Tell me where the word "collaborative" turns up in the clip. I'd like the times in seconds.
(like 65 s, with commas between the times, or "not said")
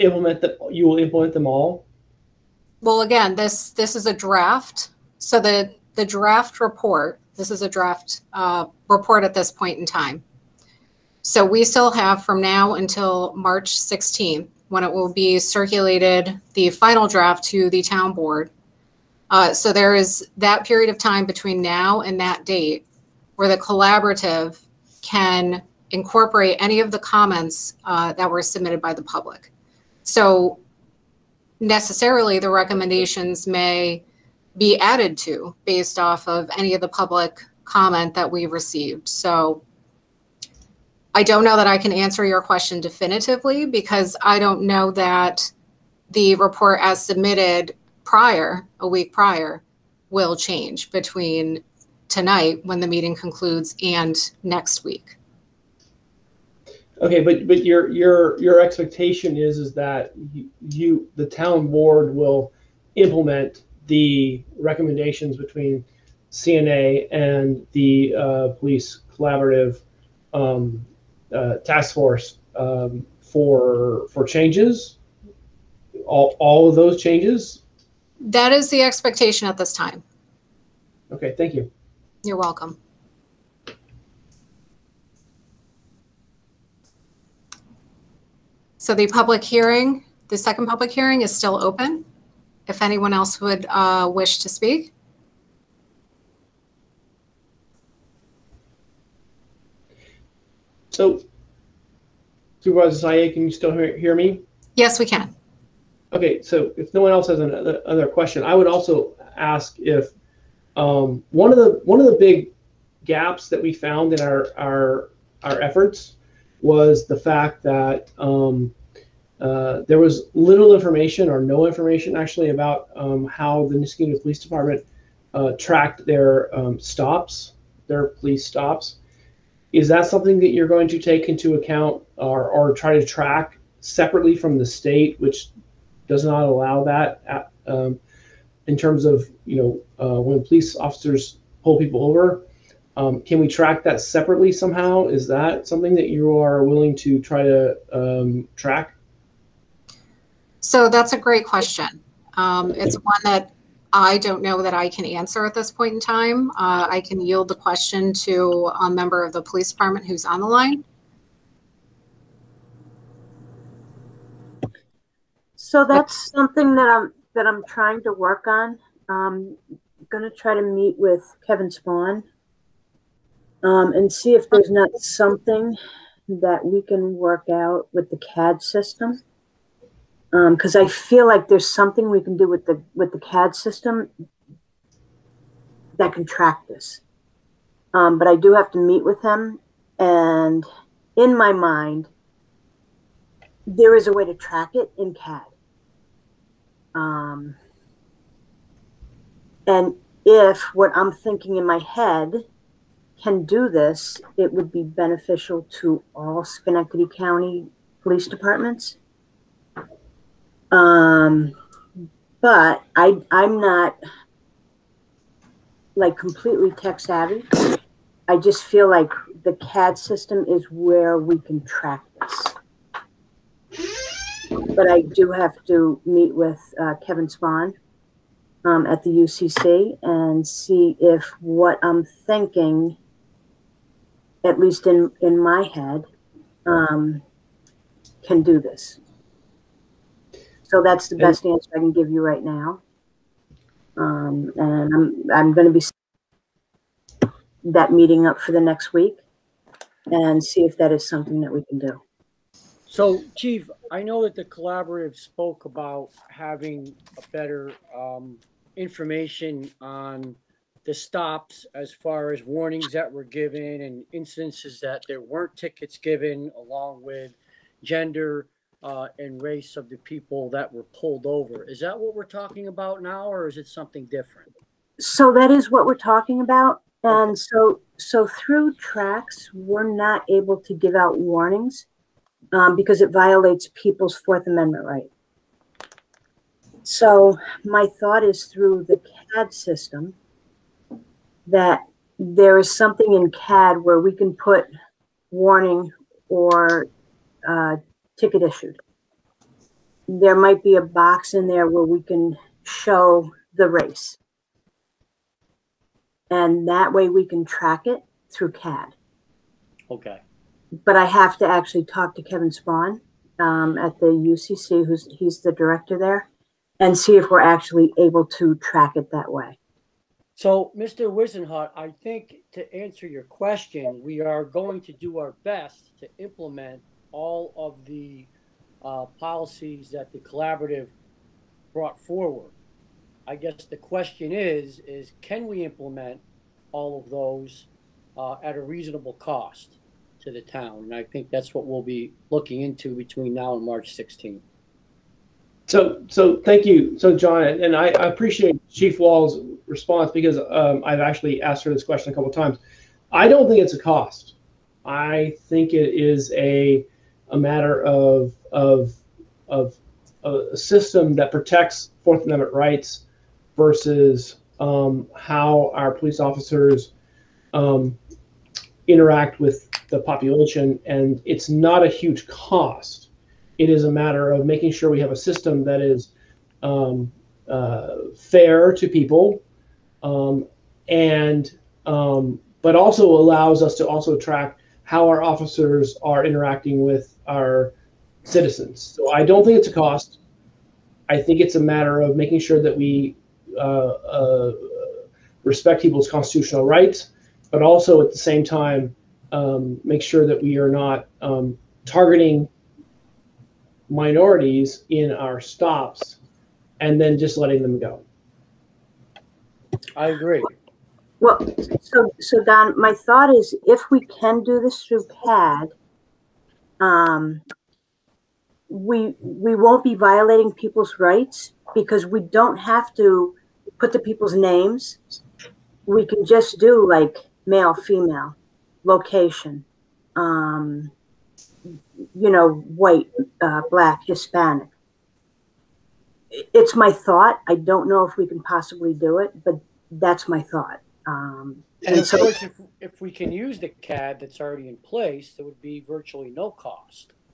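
23 s, 69 s, 254 s, 330 s.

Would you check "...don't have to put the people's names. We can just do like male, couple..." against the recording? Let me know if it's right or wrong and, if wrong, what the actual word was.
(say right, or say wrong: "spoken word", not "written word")
wrong: "female", not "couple".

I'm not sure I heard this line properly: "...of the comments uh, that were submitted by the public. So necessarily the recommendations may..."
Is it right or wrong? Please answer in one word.
right.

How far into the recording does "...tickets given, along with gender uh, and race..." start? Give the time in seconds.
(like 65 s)
265 s.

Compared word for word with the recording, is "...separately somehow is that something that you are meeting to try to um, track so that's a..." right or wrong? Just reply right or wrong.
wrong.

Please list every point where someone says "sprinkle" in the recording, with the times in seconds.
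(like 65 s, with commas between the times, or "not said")
not said.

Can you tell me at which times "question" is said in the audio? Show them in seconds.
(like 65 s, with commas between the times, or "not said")
42 s, 108 s, 151 s, 157 s, 323 s, 333 s, 351 s.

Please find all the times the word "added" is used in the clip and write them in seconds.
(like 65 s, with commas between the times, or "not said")
34 s.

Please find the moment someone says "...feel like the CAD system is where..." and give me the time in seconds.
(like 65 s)
218 s.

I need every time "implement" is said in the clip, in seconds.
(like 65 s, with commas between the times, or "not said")
0 s, 62 s, 326 s, 335 s.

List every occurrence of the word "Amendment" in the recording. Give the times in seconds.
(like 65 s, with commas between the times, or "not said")
284 s, 362 s.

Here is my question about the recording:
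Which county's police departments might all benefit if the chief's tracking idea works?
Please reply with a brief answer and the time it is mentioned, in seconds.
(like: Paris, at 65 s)
Schenectady County, at 206 s.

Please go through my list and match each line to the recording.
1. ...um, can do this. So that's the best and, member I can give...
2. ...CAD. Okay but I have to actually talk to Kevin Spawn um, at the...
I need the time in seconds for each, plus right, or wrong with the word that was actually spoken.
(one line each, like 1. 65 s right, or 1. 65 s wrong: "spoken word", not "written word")
1. 236 s wrong: "answer", not "member"
2. 308 s right.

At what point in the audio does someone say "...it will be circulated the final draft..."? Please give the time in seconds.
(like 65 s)
14 s.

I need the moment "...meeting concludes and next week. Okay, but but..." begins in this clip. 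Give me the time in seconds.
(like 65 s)
52 s.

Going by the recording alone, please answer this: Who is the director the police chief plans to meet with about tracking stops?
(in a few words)
Kevin Spahn.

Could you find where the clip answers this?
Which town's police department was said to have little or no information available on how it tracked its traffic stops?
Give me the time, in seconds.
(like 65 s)
123 s.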